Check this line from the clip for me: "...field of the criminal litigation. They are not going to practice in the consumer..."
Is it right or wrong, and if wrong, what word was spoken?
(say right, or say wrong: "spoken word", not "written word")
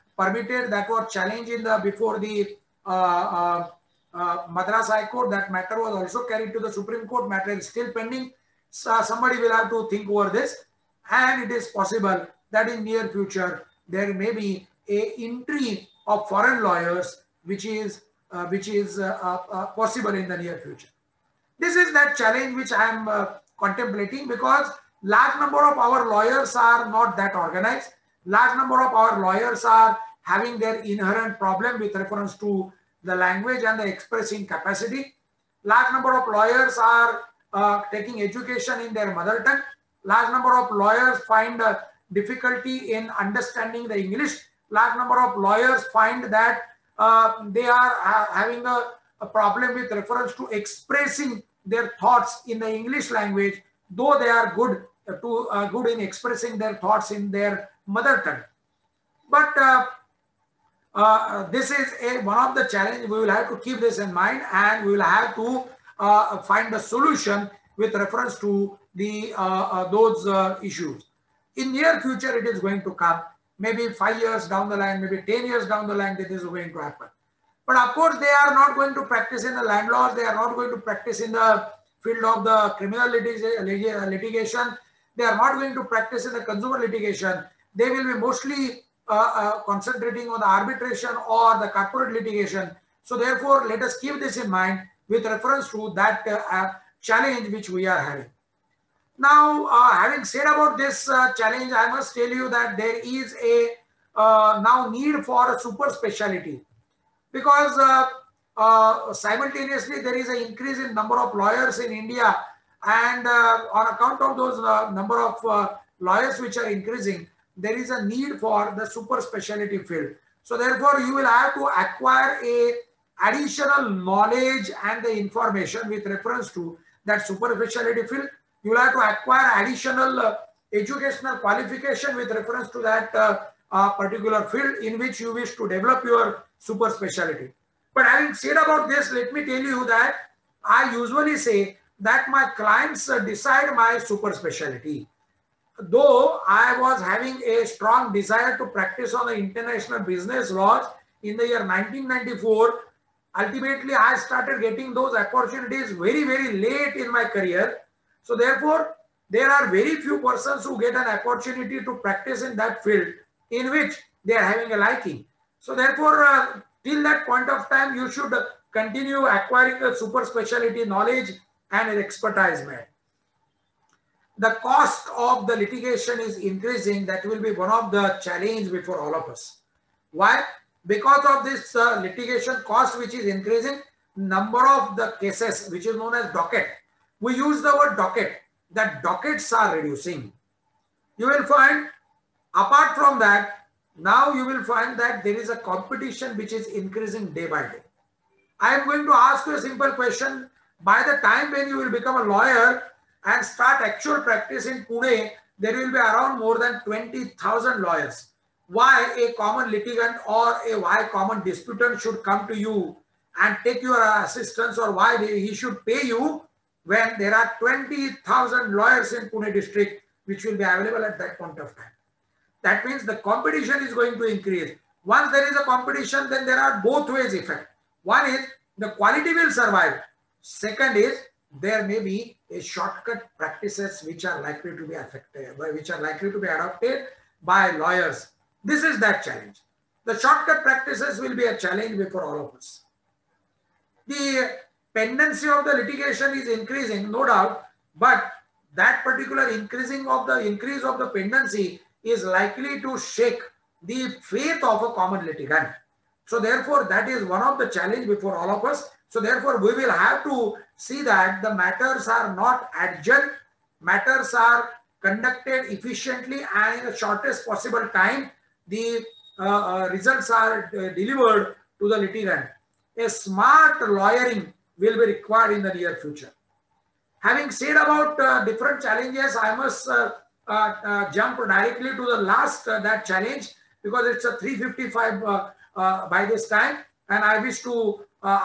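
right.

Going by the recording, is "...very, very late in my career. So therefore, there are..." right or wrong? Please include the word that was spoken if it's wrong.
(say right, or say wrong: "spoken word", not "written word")
right.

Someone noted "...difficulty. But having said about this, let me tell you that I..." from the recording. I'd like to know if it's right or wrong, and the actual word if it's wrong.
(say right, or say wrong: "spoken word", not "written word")
wrong: "specialty", not "difficulty".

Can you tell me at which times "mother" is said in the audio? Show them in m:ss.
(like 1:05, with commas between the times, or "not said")
0:39, 0:57.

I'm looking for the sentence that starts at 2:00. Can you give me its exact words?
So therefore you will have to acquire a additional knowledge and the information with reference to that super speciality field.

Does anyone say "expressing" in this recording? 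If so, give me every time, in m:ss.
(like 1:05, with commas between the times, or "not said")
0:33, 0:50, 0:56.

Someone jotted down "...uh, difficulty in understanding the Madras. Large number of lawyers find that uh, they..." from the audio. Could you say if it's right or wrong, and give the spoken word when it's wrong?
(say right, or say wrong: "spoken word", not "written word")
wrong: "English", not "Madras".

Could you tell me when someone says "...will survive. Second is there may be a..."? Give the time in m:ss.
3:49.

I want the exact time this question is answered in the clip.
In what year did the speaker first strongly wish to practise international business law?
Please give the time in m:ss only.
2:31.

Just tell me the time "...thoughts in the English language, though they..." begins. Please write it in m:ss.
0:52.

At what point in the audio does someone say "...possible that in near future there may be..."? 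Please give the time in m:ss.
0:11.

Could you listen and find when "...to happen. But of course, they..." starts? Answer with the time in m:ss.
1:16.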